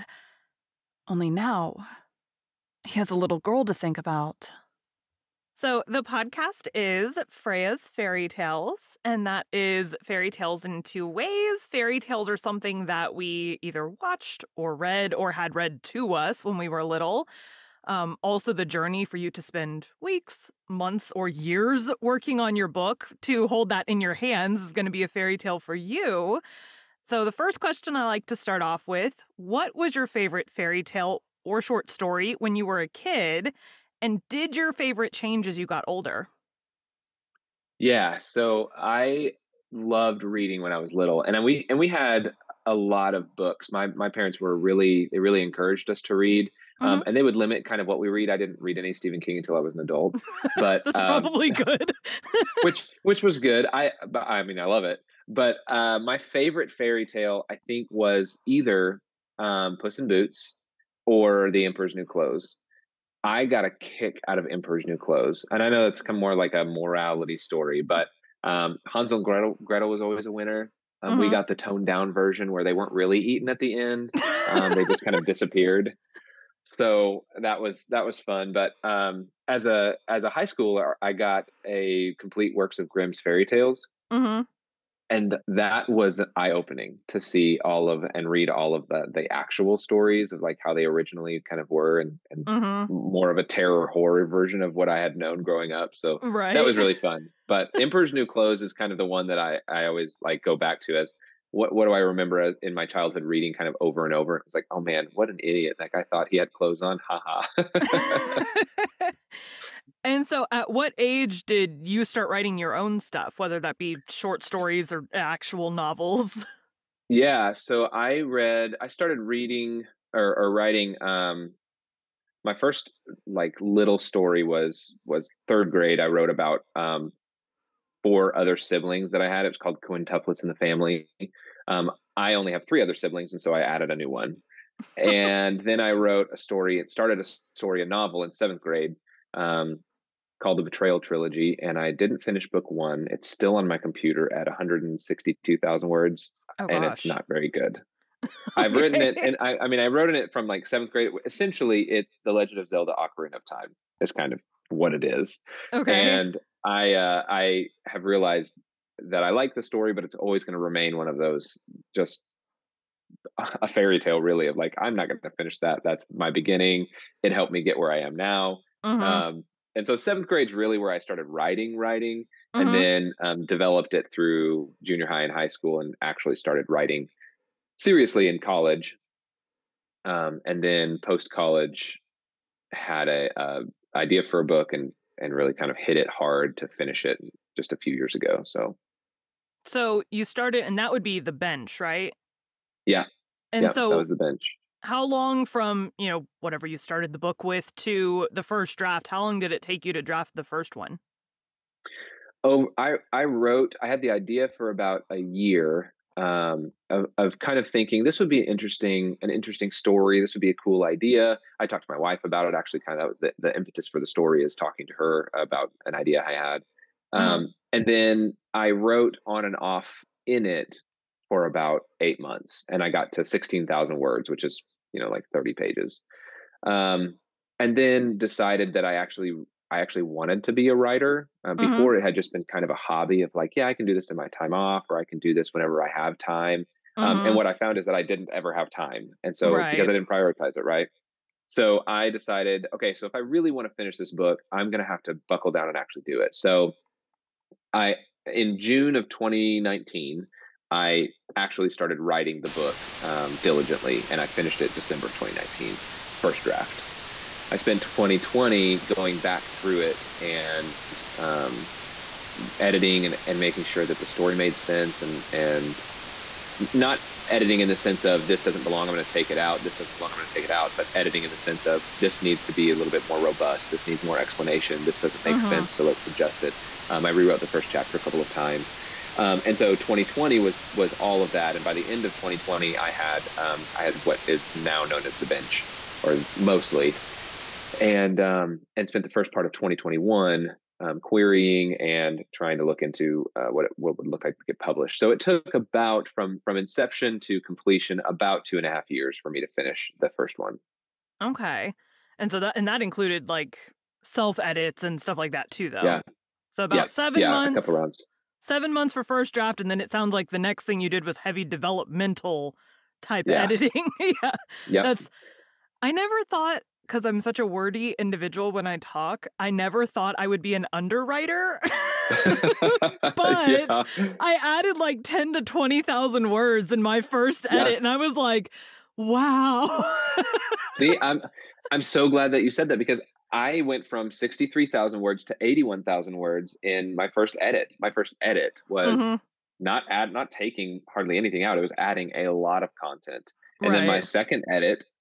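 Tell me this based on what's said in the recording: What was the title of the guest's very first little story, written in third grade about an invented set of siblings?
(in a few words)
Quintuplets in the Family.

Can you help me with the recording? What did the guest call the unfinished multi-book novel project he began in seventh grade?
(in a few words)
The Betrayal Trilogy.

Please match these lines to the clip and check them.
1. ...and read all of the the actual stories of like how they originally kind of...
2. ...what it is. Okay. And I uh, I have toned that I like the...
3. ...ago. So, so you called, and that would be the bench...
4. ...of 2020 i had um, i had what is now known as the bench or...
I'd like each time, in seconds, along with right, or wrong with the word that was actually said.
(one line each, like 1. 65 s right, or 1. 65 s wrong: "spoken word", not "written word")
1. 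88 s right
2. 154 s wrong: "realized", not "toned"
3. 188 s wrong: "started", not "called"
4. 282 s right.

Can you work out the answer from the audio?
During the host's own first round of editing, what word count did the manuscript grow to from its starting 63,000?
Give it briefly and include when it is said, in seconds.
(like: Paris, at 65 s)
81,000, at 335 s.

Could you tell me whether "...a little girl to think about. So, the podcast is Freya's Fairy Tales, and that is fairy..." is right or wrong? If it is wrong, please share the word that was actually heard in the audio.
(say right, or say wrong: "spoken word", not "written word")
right.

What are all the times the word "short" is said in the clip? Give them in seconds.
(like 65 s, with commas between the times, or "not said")
31 s, 114 s.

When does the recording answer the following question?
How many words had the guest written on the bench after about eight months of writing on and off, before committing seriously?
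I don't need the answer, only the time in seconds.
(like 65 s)
223 s.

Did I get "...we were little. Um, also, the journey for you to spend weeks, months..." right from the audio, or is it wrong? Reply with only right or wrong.
right.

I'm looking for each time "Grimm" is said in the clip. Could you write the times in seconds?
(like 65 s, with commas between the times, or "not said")
82 s.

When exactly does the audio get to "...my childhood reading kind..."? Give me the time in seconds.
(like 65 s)
102 s.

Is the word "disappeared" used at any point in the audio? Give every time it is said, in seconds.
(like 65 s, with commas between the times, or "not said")
75 s.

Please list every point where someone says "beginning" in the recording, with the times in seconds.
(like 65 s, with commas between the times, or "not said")
166 s.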